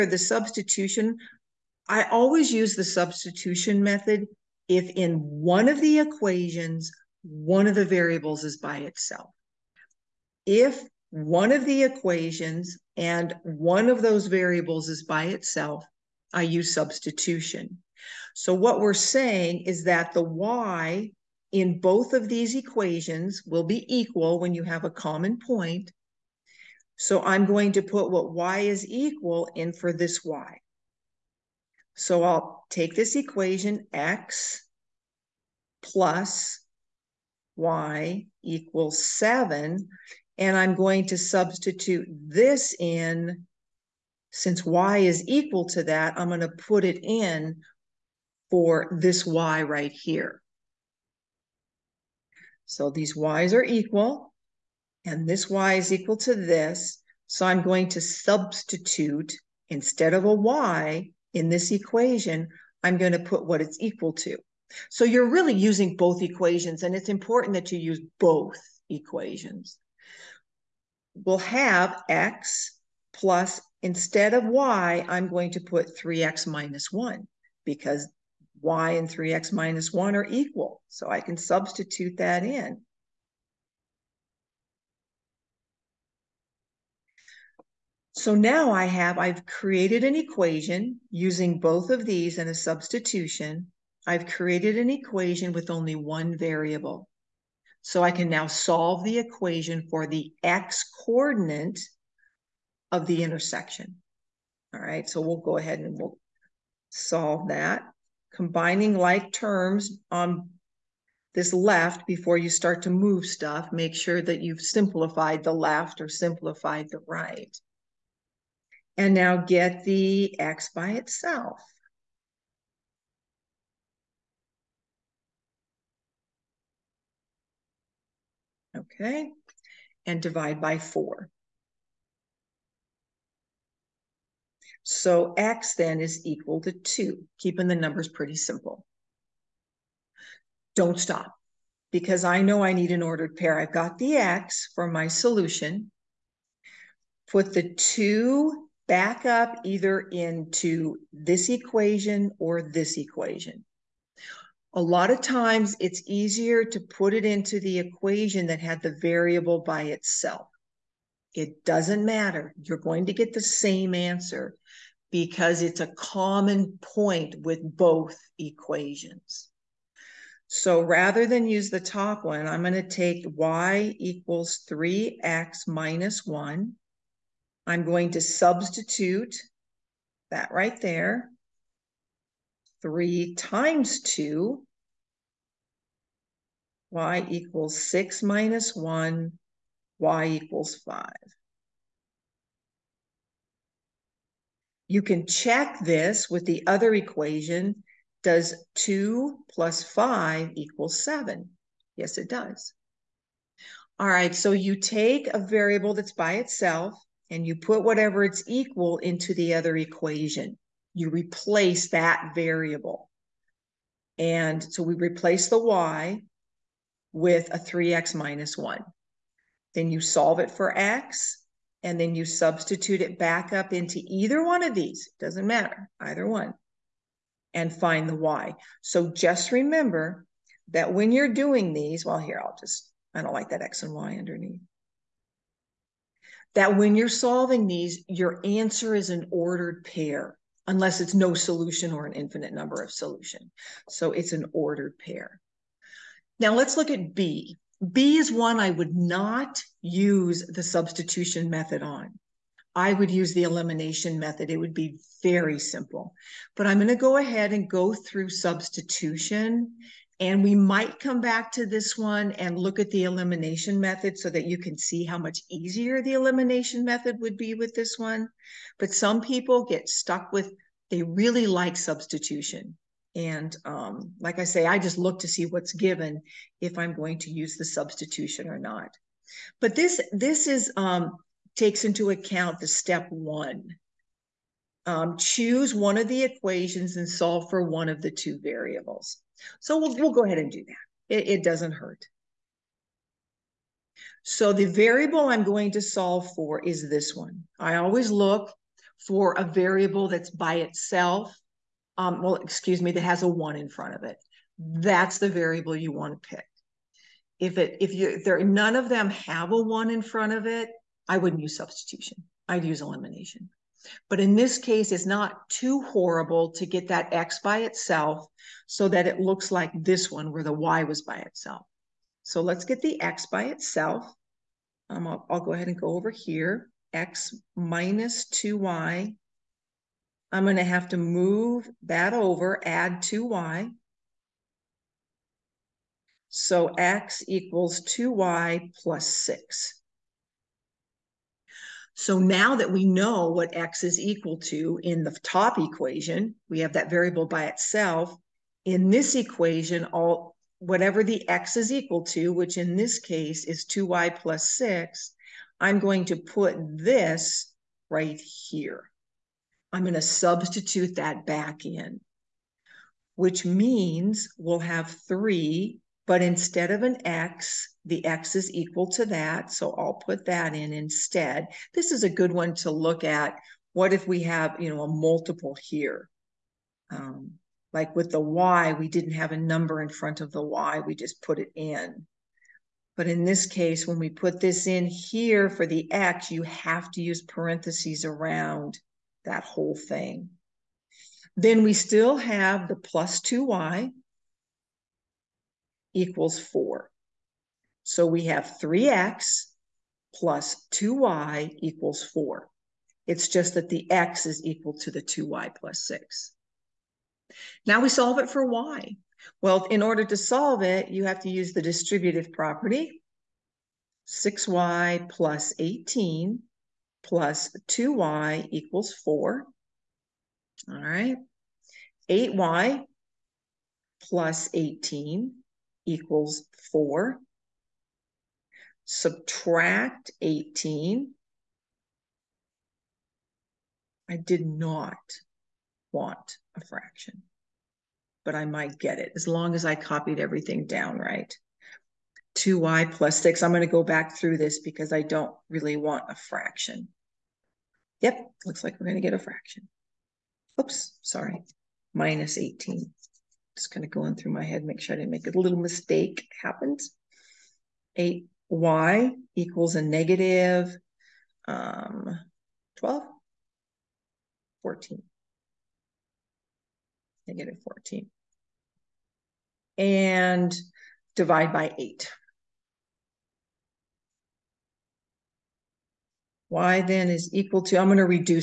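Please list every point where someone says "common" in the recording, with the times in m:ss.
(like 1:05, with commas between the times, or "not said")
0:24, 2:45.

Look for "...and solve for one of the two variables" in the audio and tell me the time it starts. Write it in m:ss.
4:46.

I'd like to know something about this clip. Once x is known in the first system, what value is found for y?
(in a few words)
5.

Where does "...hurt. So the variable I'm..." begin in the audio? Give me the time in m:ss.
4:51.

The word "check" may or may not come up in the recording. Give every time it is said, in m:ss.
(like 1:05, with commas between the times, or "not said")
3:15.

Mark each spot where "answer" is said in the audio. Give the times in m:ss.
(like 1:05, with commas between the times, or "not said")
2:43, 3:58.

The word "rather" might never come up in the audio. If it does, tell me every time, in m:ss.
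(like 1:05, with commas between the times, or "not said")
2:50.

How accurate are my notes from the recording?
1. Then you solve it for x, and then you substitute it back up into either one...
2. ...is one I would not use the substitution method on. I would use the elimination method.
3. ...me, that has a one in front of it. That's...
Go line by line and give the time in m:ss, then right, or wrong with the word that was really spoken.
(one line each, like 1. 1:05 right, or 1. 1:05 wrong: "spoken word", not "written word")
1. 3:39 right
2. 4:08 right
3. 5:02 right.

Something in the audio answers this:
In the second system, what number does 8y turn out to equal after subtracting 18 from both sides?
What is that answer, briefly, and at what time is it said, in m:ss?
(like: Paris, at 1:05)
-14, at 7:47.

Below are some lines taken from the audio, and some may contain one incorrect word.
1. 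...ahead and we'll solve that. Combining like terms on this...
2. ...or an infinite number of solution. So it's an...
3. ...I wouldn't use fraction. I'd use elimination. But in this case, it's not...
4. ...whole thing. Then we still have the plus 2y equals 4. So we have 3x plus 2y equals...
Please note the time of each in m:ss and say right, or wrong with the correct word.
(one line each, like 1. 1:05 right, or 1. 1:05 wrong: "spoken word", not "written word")
1. 1:45 right
2. 4:01 right
3. 5:11 wrong: "substitution", not "fraction"
4. 6:29 right.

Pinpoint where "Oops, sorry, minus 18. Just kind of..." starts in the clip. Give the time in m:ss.
7:30.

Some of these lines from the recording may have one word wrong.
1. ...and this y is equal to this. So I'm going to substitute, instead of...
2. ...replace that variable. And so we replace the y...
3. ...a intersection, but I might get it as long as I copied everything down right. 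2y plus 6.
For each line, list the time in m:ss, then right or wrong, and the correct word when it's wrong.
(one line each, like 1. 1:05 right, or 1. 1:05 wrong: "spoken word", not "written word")
1. 0:55 right
2. 3:31 right
3. 7:16 wrong: "fraction", not "intersection".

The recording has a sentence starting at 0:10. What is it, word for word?
If one of the equations and one of those variables is by itself, I use substitution.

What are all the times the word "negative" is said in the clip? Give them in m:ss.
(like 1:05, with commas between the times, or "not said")
7:39, 7:47.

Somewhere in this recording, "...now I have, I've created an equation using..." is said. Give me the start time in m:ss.
1:28.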